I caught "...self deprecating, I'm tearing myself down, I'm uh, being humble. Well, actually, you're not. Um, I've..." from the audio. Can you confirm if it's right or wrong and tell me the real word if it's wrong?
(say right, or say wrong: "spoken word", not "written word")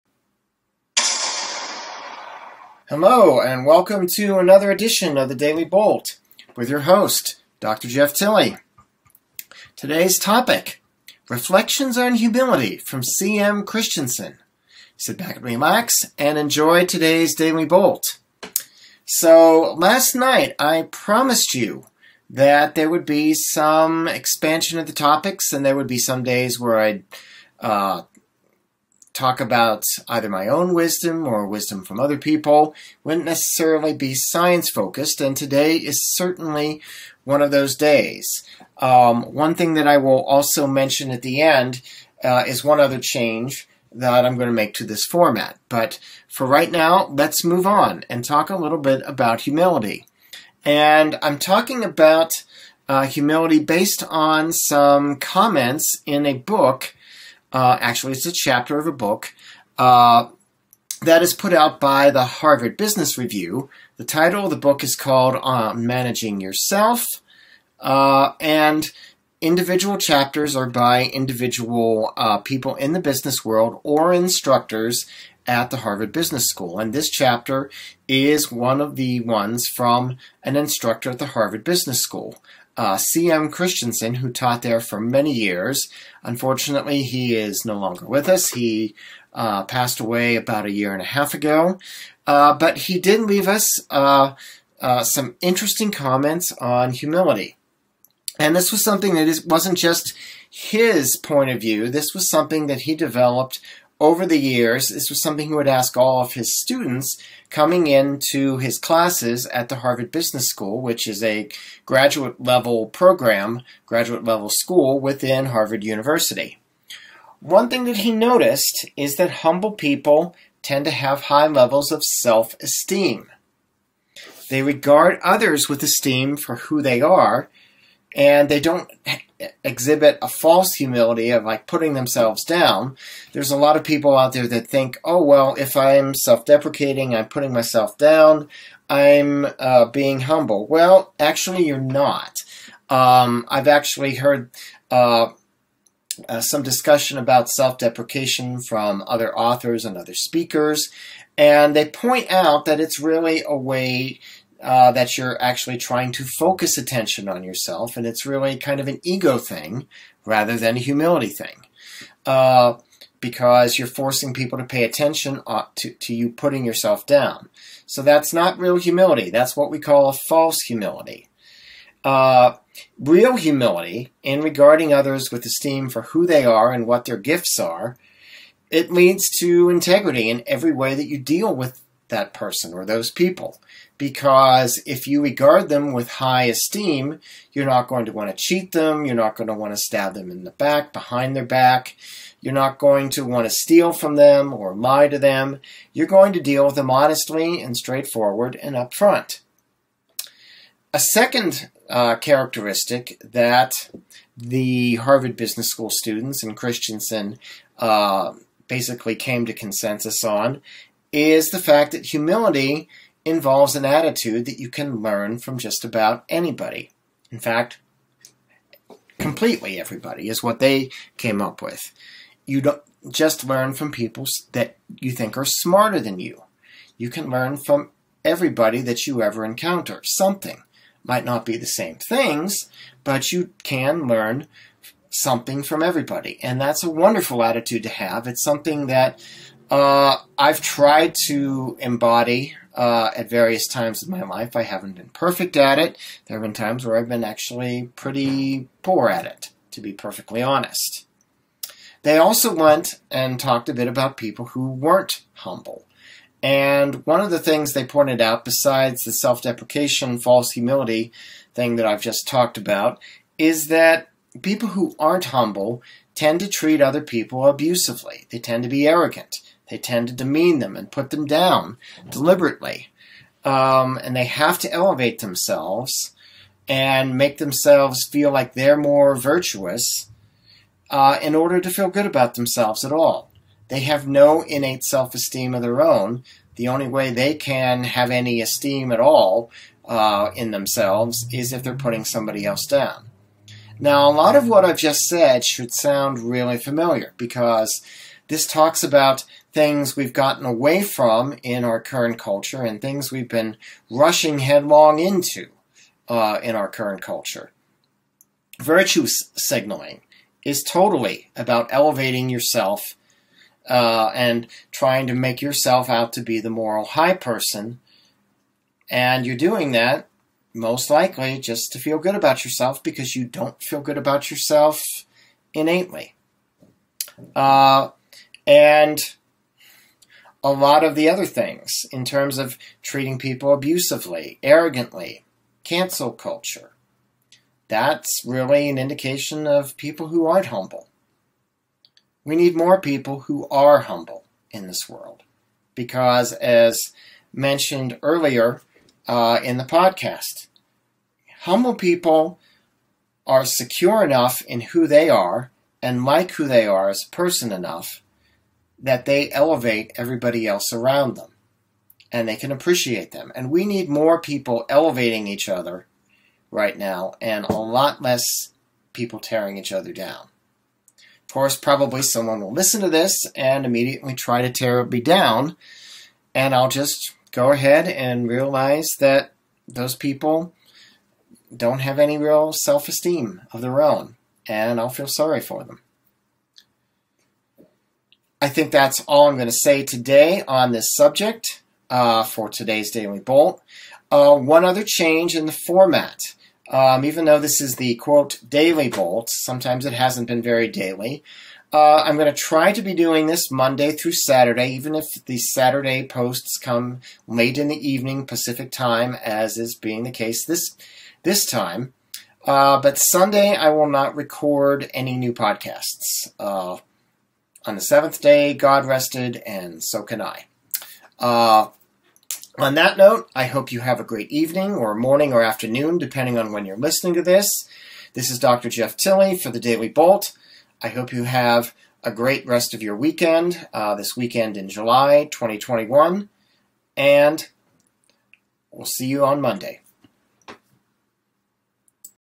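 wrong: "putting", not "tearing".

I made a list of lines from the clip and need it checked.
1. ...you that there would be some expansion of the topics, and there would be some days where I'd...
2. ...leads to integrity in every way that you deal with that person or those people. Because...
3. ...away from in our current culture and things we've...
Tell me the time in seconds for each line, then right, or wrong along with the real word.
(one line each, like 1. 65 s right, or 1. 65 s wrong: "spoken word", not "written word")
1. 21 s right
2. 178 s right
3. 300 s right.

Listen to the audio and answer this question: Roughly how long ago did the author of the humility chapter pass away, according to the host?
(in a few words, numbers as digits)
a year and a half.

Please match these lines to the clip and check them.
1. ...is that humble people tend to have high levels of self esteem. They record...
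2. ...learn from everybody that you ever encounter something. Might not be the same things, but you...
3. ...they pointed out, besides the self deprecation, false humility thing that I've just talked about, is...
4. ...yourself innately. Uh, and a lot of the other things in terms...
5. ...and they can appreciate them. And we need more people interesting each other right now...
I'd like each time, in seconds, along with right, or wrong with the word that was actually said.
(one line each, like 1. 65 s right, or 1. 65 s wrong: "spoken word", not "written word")
1. 118 s wrong: "regard", not "record"
2. 227 s right
3. 257 s right
4. 324 s right
5. 362 s wrong: "elevating", not "interesting".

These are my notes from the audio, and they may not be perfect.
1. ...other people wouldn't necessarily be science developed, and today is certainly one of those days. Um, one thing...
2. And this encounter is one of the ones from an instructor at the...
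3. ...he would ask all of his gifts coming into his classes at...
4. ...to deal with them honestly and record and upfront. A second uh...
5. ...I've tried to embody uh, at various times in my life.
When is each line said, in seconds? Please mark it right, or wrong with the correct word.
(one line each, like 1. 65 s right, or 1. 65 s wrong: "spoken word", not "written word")
1. 31 s wrong: "focused", not "developed"
2. 76 s wrong: "chapter", not "encounter"
3. 105 s wrong: "students", not "gifts"
4. 196 s wrong: "straightforward", not "record"
5. 240 s right.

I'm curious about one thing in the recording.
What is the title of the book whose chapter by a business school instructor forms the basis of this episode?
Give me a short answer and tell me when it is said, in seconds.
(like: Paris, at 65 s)
Managing Yourself, at 65 s.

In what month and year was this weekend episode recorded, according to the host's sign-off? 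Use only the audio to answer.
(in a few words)
July 2021.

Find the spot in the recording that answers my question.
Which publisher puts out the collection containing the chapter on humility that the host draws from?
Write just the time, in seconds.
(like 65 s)
62 s.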